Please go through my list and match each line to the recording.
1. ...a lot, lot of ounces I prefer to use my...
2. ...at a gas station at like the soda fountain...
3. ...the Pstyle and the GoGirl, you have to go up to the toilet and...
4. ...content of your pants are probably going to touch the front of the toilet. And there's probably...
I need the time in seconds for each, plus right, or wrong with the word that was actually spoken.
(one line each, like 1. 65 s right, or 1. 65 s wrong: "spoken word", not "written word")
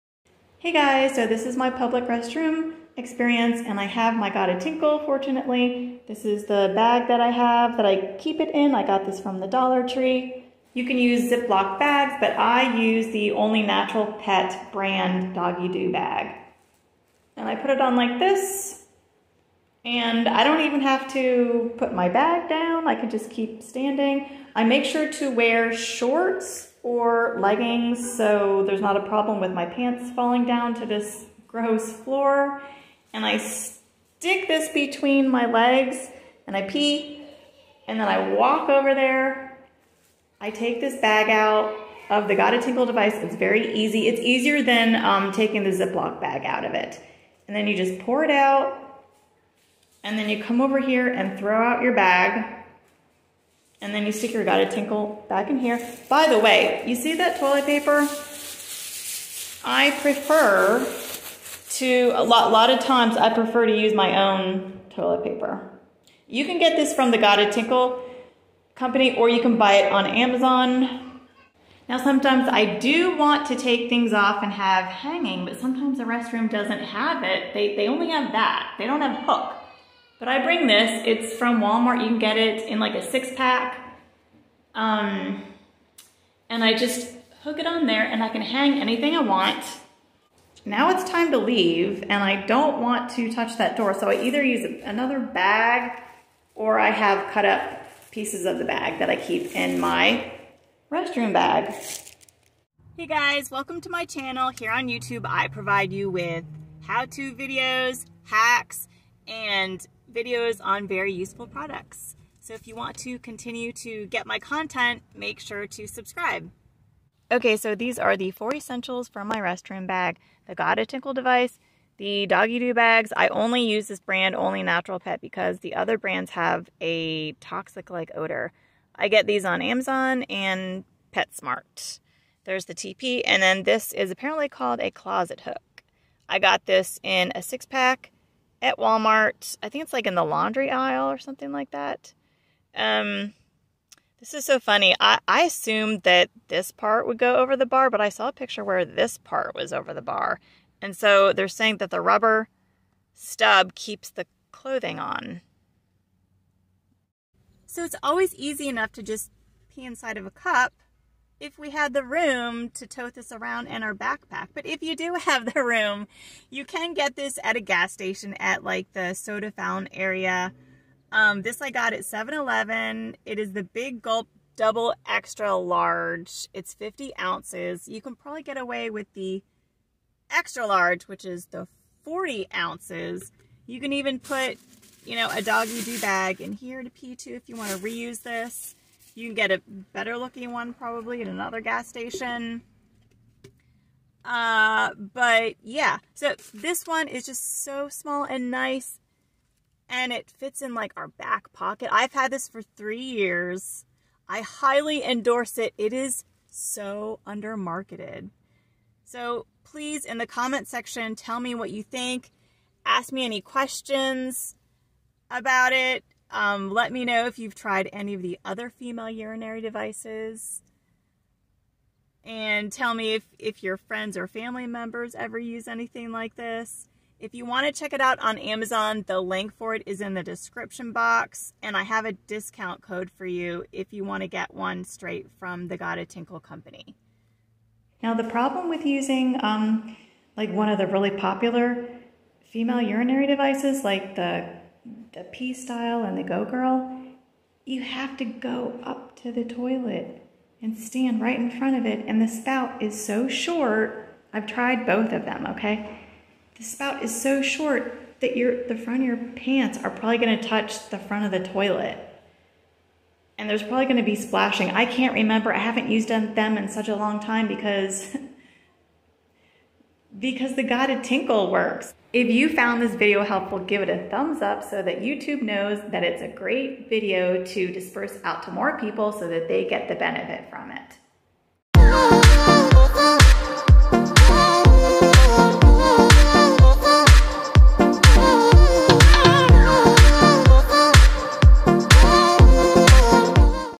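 1. 62 s wrong: "times", not "ounces"
2. 167 s right
3. 245 s right
4. 258 s wrong: "front", not "content".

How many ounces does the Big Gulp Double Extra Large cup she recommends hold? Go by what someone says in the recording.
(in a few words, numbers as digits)
50.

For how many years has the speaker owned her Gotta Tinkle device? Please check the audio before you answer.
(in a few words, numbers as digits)
3.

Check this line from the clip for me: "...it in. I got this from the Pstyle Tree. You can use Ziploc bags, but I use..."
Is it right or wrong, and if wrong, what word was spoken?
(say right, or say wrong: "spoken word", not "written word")
wrong: "Dollar", not "Pstyle".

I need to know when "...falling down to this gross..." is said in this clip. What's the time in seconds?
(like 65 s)
30 s.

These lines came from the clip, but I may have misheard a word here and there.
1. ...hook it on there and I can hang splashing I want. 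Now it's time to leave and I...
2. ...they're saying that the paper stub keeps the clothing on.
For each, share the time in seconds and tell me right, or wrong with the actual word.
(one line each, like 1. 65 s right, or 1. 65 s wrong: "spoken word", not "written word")
1. 87 s wrong: "anything", not "splashing"
2. 151 s wrong: "rubber", not "paper".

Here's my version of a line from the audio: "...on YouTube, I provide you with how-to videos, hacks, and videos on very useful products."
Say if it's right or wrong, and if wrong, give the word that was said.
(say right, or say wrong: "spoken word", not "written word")
right.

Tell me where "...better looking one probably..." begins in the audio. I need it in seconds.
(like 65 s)
189 s.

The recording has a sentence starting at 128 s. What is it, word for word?
I get these on Amazon and PetSmart.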